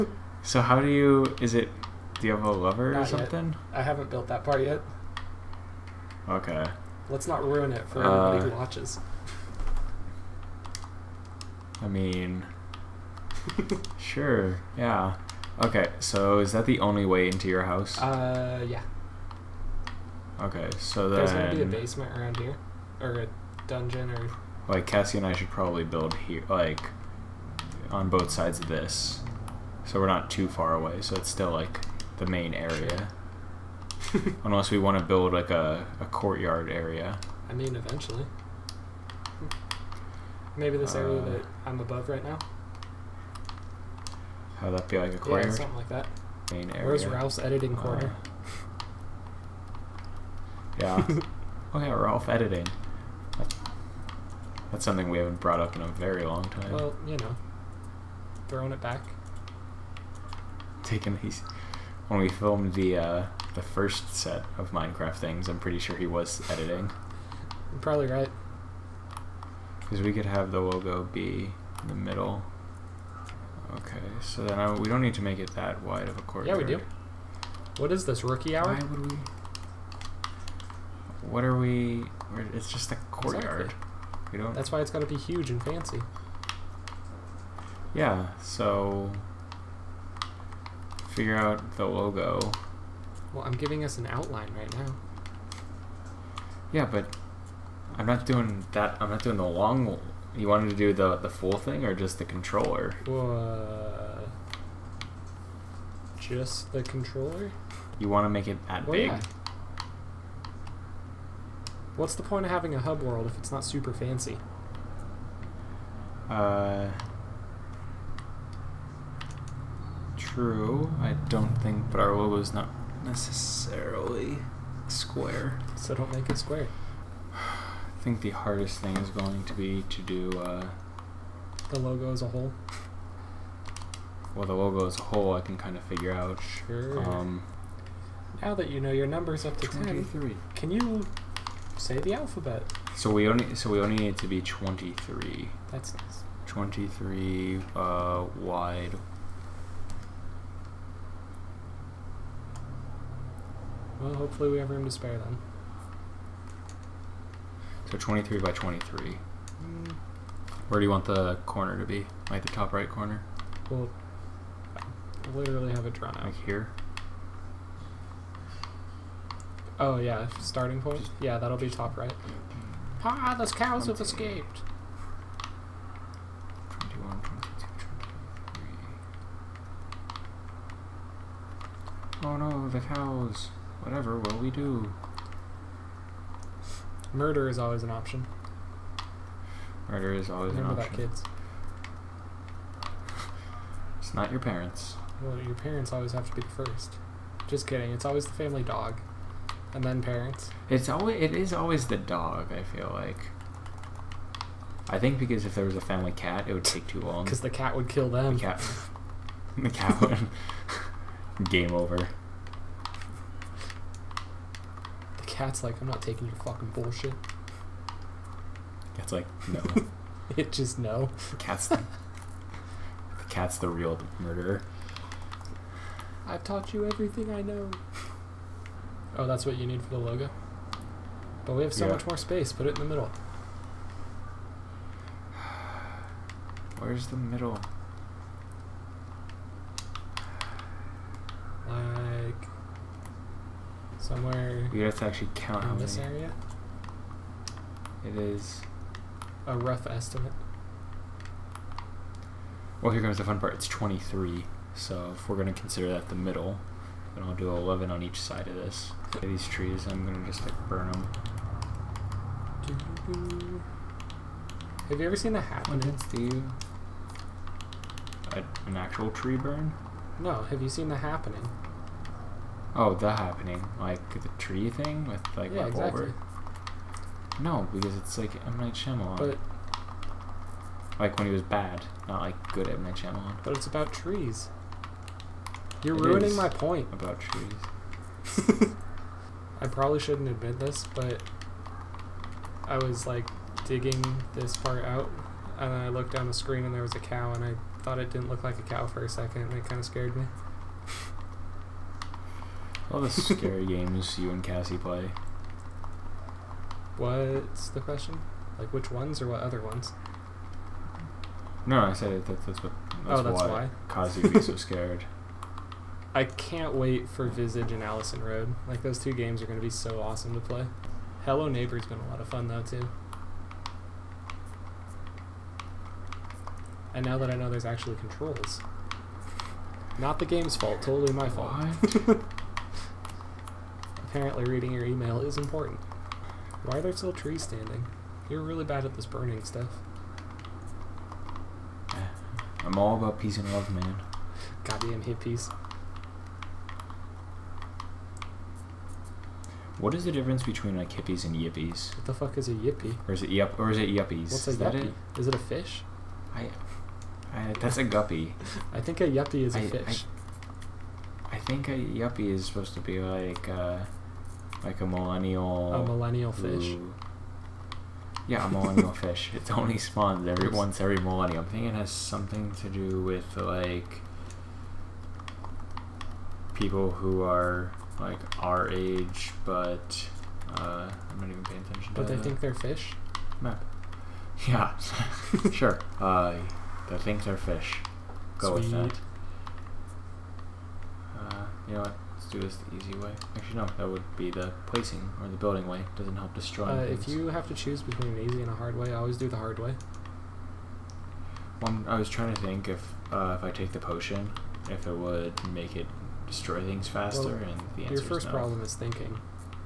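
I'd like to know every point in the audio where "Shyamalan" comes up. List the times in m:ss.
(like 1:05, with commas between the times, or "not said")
4:38, 4:42.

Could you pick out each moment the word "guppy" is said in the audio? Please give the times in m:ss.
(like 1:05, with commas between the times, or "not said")
5:57.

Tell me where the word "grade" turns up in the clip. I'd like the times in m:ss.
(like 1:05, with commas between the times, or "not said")
not said.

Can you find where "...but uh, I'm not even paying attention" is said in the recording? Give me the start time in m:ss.
6:19.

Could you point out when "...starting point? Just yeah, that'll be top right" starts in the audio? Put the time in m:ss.
2:50.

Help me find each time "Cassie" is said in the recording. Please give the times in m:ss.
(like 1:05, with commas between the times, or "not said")
0:24, 5:04, 5:13.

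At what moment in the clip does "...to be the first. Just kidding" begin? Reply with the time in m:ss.
3:16.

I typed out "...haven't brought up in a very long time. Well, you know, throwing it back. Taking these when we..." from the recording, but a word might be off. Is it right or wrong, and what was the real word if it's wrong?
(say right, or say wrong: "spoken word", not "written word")
right.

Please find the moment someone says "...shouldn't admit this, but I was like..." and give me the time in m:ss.
4:49.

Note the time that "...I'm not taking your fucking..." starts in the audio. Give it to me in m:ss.
3:35.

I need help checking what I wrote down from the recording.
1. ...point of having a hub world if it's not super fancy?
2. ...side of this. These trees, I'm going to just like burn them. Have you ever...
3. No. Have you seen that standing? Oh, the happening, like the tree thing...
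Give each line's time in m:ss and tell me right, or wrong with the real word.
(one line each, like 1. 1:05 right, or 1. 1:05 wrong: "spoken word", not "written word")
1. 1:52 right
2. 4:18 right
3. 4:30 wrong: "happening", not "standing".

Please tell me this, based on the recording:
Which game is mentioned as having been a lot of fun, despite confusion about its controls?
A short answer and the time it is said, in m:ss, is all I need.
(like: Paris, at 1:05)
Hello Neighbor, at 5:21.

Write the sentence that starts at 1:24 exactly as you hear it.
That's why it's got to be huge and fancy.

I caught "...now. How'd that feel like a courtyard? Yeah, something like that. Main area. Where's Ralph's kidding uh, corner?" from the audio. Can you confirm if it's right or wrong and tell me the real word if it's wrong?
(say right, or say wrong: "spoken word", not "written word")
wrong: "editing", not "kidding".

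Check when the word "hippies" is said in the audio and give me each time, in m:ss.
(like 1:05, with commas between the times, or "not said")
5:45, 5:50.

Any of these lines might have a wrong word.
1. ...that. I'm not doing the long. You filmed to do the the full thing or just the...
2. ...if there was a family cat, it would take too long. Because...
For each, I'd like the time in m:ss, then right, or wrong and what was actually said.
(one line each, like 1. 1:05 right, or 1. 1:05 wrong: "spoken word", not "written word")
1. 1:38 wrong: "wanted", not "filmed"
2. 3:25 right.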